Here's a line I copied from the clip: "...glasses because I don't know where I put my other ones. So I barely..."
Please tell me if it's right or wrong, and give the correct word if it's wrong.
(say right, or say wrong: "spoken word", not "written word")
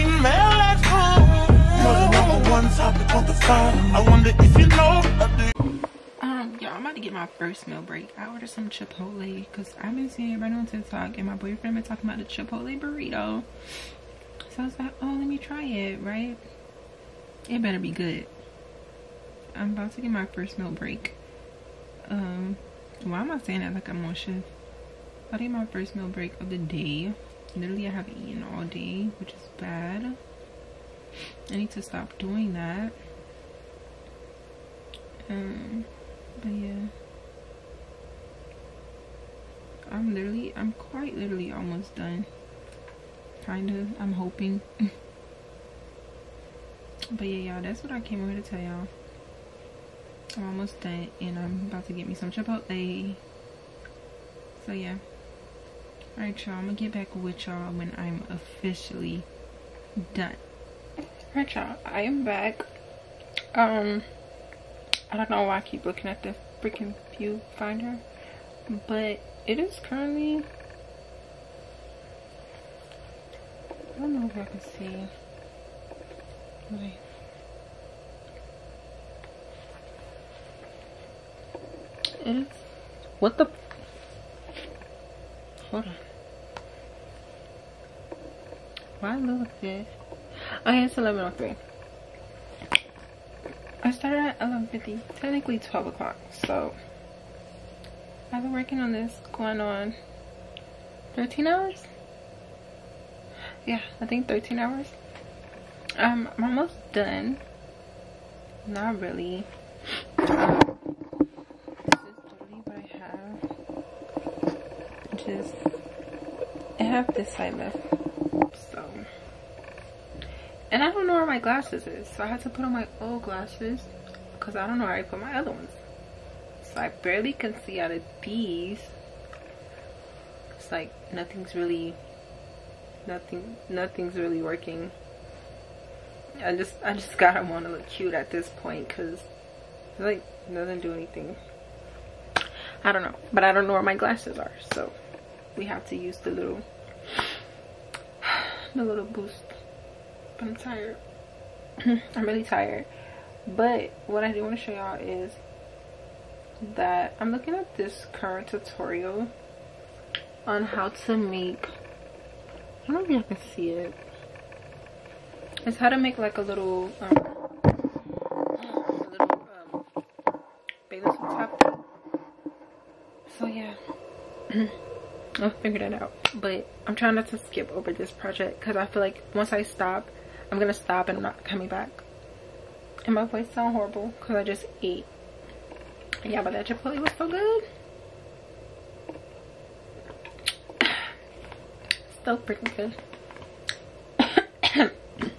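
right.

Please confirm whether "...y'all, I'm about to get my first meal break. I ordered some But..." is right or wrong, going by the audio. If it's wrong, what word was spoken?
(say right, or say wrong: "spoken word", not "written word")
wrong: "Chipotle", not "But".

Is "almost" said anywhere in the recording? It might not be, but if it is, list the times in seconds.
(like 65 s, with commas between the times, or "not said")
41 s, 50 s, 106 s.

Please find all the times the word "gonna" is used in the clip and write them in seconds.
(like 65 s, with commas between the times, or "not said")
56 s, 180 s.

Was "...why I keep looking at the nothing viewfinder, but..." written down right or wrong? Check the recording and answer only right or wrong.
wrong.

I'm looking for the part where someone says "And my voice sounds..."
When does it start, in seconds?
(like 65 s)
183 s.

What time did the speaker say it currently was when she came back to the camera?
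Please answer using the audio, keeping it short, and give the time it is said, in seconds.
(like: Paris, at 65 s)
11.03, at 90 s.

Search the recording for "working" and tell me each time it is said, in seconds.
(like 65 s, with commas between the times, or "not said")
98 s, 134 s.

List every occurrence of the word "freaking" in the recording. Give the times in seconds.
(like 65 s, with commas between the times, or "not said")
66 s, 192 s.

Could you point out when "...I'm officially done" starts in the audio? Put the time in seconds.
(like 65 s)
57 s.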